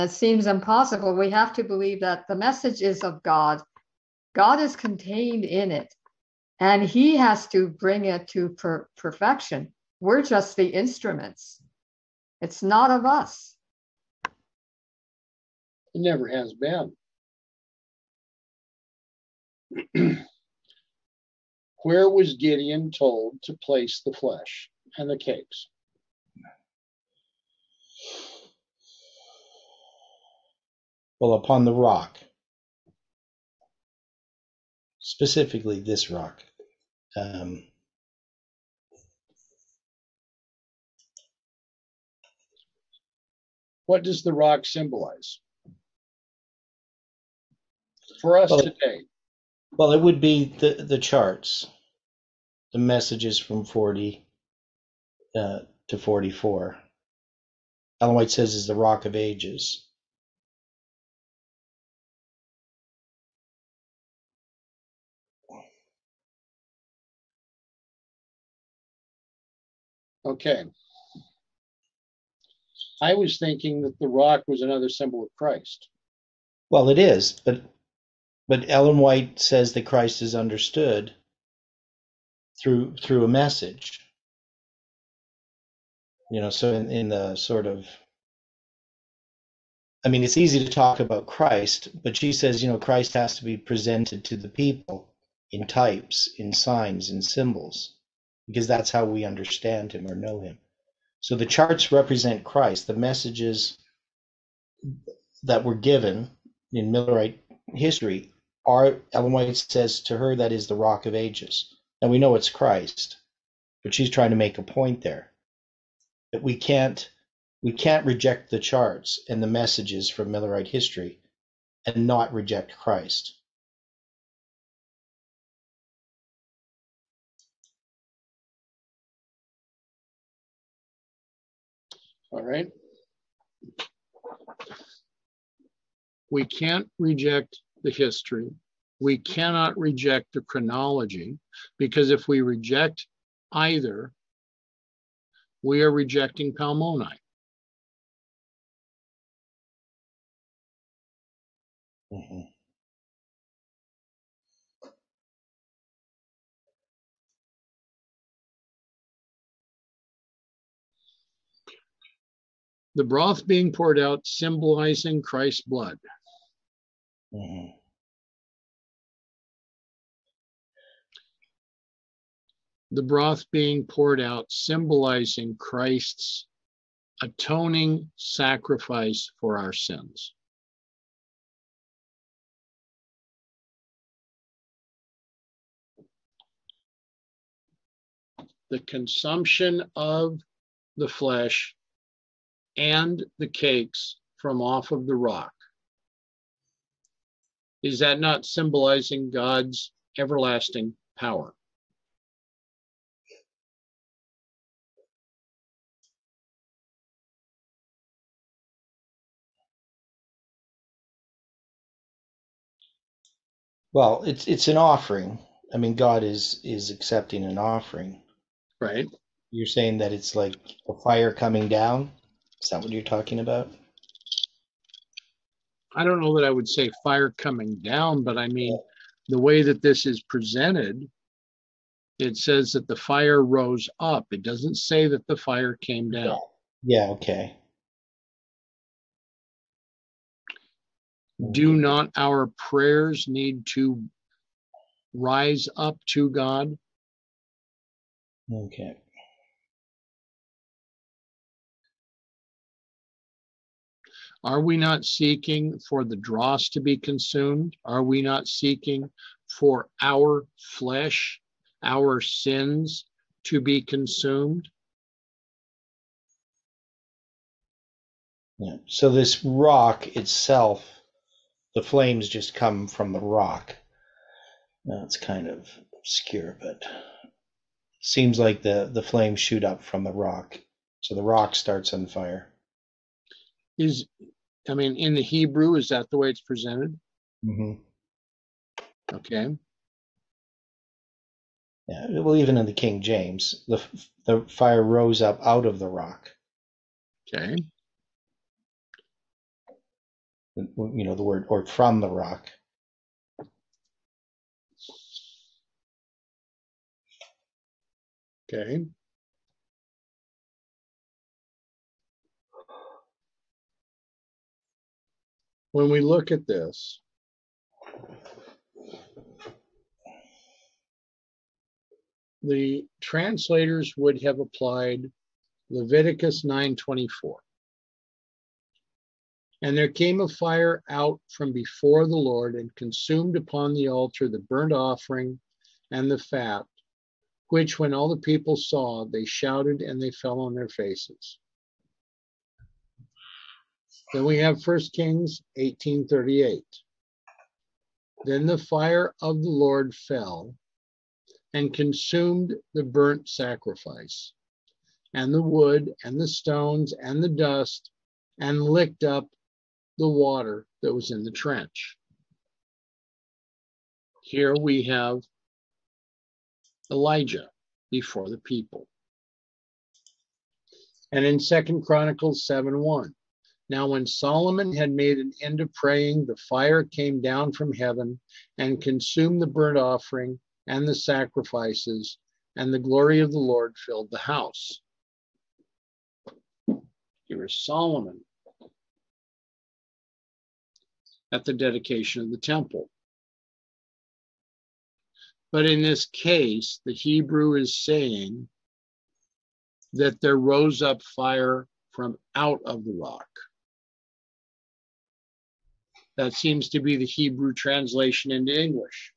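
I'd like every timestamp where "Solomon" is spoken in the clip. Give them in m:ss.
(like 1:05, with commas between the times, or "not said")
6:14, 6:27.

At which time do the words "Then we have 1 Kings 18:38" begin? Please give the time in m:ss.
5:44.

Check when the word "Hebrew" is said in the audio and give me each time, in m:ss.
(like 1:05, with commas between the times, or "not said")
4:45, 6:36, 6:47.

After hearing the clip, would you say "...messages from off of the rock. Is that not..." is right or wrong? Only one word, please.
wrong.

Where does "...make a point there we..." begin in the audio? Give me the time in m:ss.
1:54.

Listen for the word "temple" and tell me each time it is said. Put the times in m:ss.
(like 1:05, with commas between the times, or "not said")
6:32.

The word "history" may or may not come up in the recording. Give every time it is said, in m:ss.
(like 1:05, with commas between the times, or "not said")
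1:47, 2:00, 2:17.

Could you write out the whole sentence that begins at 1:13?
I was thinking that the rock was another symbol of Christ.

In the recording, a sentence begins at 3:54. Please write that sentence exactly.
It doesn't say that the fire came down.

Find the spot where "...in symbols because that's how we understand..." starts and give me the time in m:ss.
1:37.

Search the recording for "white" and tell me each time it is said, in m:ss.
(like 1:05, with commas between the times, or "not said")
0:58, 1:18, 1:49.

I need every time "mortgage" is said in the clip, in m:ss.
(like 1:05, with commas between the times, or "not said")
not said.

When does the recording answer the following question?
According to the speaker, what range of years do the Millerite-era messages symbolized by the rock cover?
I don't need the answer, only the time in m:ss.
0:53.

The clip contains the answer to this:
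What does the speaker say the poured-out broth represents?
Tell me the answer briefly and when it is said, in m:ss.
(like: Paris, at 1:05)
Christ's blood, at 2:45.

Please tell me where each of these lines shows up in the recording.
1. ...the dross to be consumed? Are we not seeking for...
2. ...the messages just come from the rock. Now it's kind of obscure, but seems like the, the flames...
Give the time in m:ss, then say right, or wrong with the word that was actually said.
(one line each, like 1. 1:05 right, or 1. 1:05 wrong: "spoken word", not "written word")
1. 4:16 right
2. 4:31 wrong: "flames", not "messages".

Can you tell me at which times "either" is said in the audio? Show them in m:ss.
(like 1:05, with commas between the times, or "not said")
2:23.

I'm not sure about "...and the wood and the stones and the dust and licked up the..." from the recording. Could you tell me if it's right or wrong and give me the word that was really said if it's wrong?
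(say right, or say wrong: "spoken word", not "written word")
right.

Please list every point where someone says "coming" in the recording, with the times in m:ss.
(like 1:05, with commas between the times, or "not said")
3:41, 3:47.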